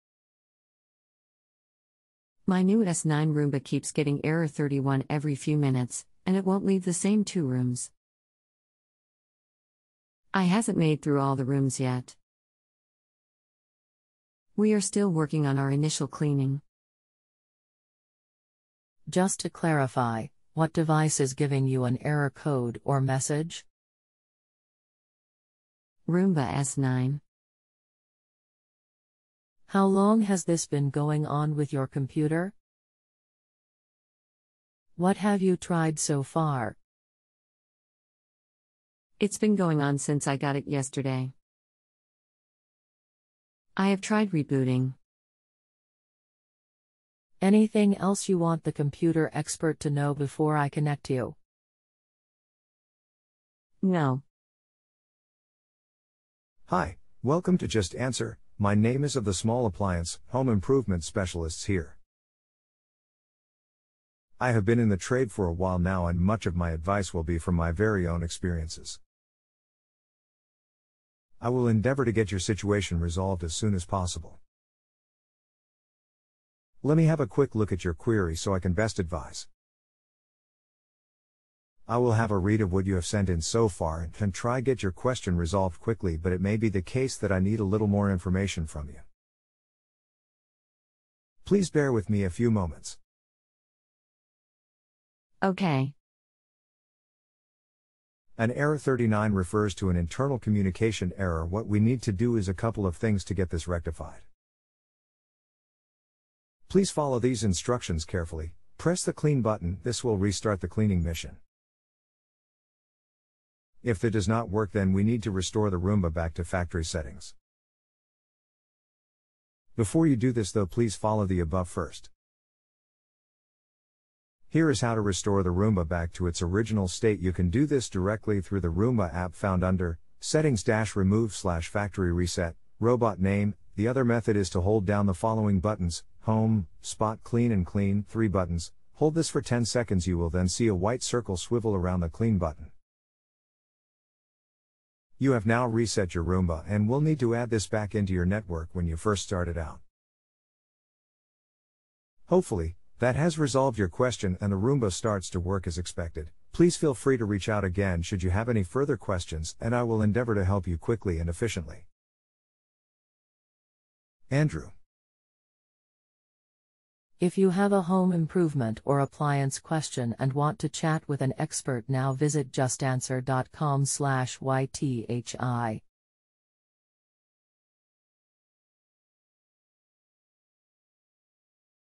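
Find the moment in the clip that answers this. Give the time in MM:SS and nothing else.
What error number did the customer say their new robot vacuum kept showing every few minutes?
00:04.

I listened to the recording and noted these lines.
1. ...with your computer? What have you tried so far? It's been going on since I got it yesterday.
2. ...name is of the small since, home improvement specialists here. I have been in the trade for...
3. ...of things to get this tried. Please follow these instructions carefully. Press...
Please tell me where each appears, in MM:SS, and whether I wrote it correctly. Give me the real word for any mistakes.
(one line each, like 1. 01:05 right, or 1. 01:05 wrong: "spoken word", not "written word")
1. 00:31 right
2. 00:58 wrong: "appliance", not "since"
3. 01:42 wrong: "rectified", not "tried".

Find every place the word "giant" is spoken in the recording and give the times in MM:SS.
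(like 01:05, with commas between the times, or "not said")
not said.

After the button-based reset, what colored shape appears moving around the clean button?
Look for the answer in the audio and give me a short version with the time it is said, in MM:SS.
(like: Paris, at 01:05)
white circle, at 02:20.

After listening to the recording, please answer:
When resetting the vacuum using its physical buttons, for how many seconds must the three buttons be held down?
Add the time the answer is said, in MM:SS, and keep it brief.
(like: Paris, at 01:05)
10, at 02:19.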